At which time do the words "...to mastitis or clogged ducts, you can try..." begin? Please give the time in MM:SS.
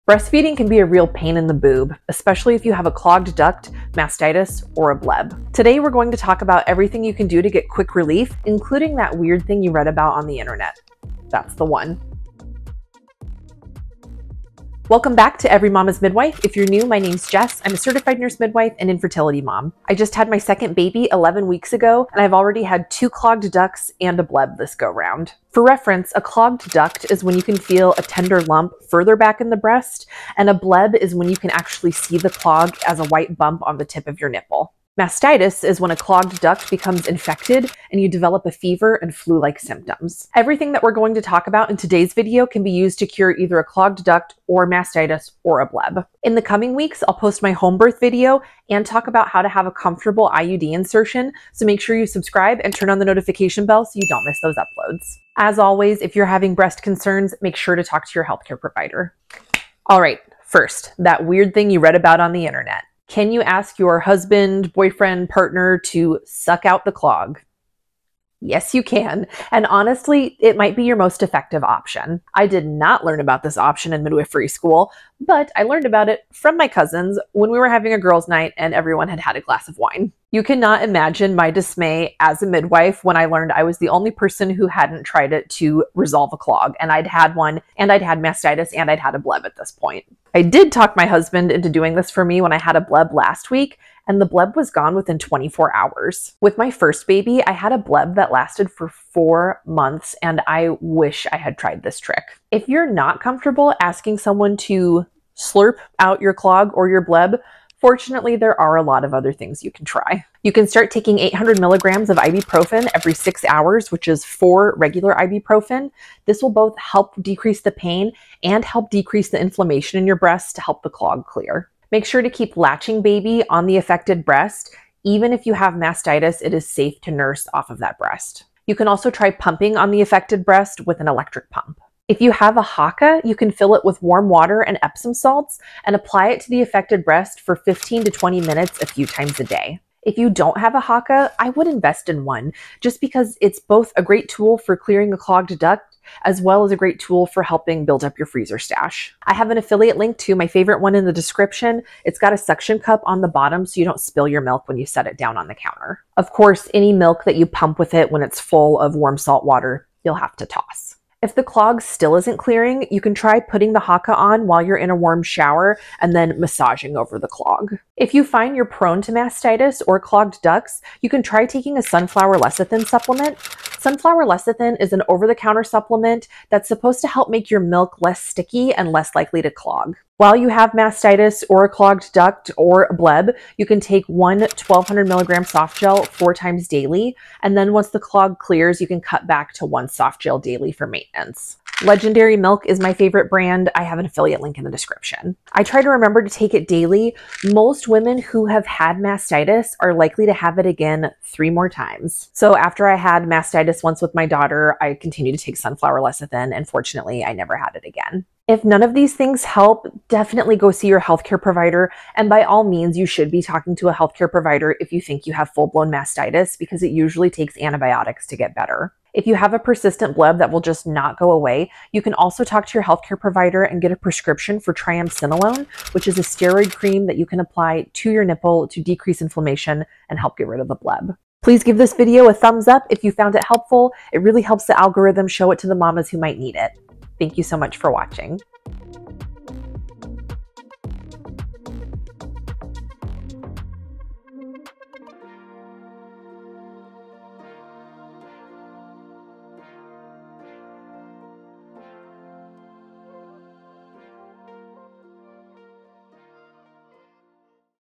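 02:49.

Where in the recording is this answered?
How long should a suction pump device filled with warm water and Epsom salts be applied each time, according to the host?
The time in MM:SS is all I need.
02:17.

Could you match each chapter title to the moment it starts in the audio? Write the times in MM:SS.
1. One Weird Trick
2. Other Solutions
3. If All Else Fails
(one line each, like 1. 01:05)
1. 00:59
2. 01:42
3. 03:28.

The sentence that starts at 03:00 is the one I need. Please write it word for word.
While you have mastitis or a clogged duct or bleb, you can take one 1200 milligram soft gel four times daily.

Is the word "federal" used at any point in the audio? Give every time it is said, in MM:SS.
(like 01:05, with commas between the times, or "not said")
not said.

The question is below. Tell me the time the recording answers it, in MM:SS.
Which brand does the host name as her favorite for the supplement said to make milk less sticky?
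03:11.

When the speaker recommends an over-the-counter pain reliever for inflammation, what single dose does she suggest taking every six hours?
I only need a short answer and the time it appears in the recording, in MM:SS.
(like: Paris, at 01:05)
800 milligrams, at 01:51.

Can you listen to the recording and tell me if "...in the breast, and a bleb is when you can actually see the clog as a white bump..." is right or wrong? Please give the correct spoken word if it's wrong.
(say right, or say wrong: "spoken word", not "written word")
right.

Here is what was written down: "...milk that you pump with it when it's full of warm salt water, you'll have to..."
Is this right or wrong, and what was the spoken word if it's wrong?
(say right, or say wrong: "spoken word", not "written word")
right.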